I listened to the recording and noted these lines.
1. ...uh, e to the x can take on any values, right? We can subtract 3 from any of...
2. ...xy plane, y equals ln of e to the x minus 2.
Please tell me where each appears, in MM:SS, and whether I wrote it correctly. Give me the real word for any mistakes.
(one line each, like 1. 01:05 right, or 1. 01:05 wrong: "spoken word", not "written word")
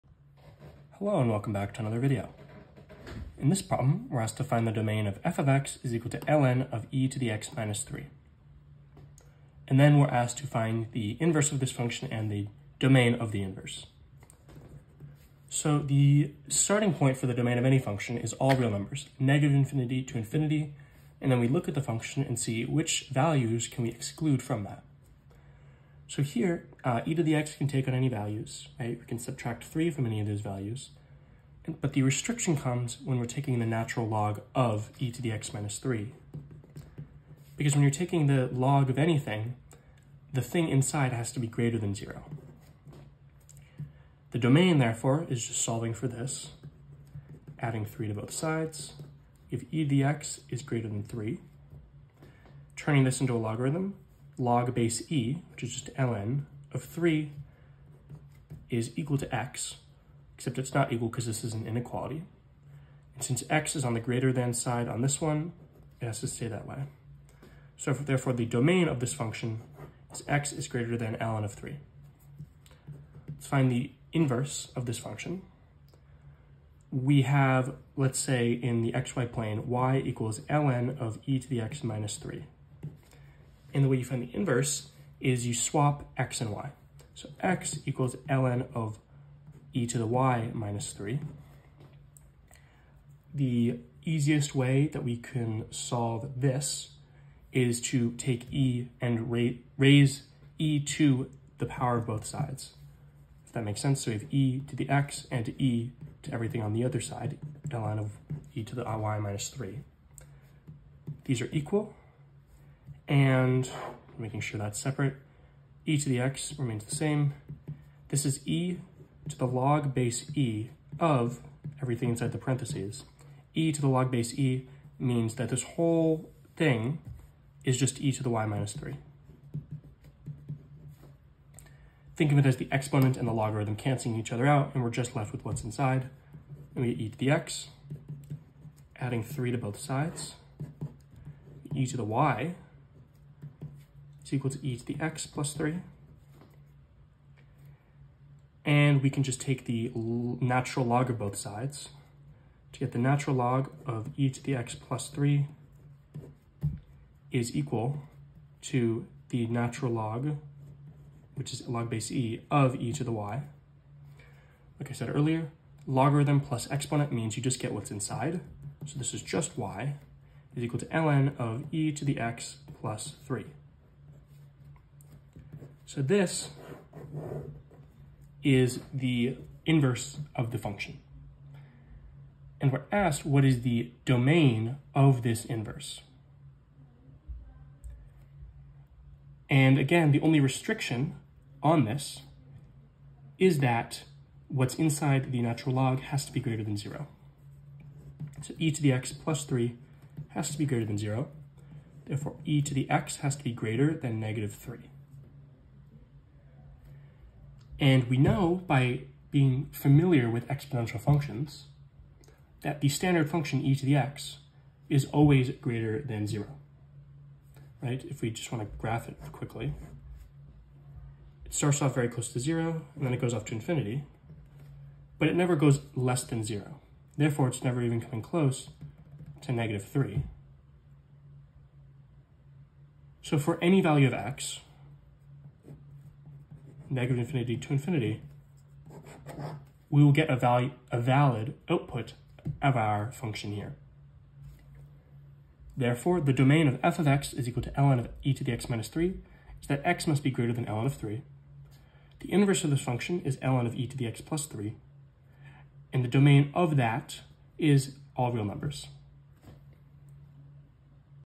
1. 00:26 right
2. 01:18 wrong: "3", not "2".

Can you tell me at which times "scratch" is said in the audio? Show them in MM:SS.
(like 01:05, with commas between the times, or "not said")
not said.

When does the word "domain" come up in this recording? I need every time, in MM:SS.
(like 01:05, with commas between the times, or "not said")
00:04, 00:12, 00:17, 00:44, 01:08, 03:04, 04:06, 04:16.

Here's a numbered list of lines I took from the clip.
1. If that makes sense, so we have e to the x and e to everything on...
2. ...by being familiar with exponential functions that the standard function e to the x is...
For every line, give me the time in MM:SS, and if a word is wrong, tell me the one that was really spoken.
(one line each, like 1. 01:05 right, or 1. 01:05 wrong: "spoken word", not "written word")
1. 01:43 right
2. 03:28 right.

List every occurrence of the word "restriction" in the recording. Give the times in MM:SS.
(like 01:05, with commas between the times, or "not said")
00:32, 03:10.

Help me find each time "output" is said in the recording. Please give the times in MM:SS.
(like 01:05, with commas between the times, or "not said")
04:01.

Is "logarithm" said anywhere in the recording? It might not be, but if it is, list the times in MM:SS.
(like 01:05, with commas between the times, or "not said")
00:53, 02:13, 02:45.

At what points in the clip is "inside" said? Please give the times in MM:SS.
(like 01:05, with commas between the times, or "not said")
00:40, 02:02, 02:15, 02:47, 03:14.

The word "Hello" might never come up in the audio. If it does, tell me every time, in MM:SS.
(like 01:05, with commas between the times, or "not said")
00:01.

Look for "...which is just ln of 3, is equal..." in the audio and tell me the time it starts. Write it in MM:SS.
00:55.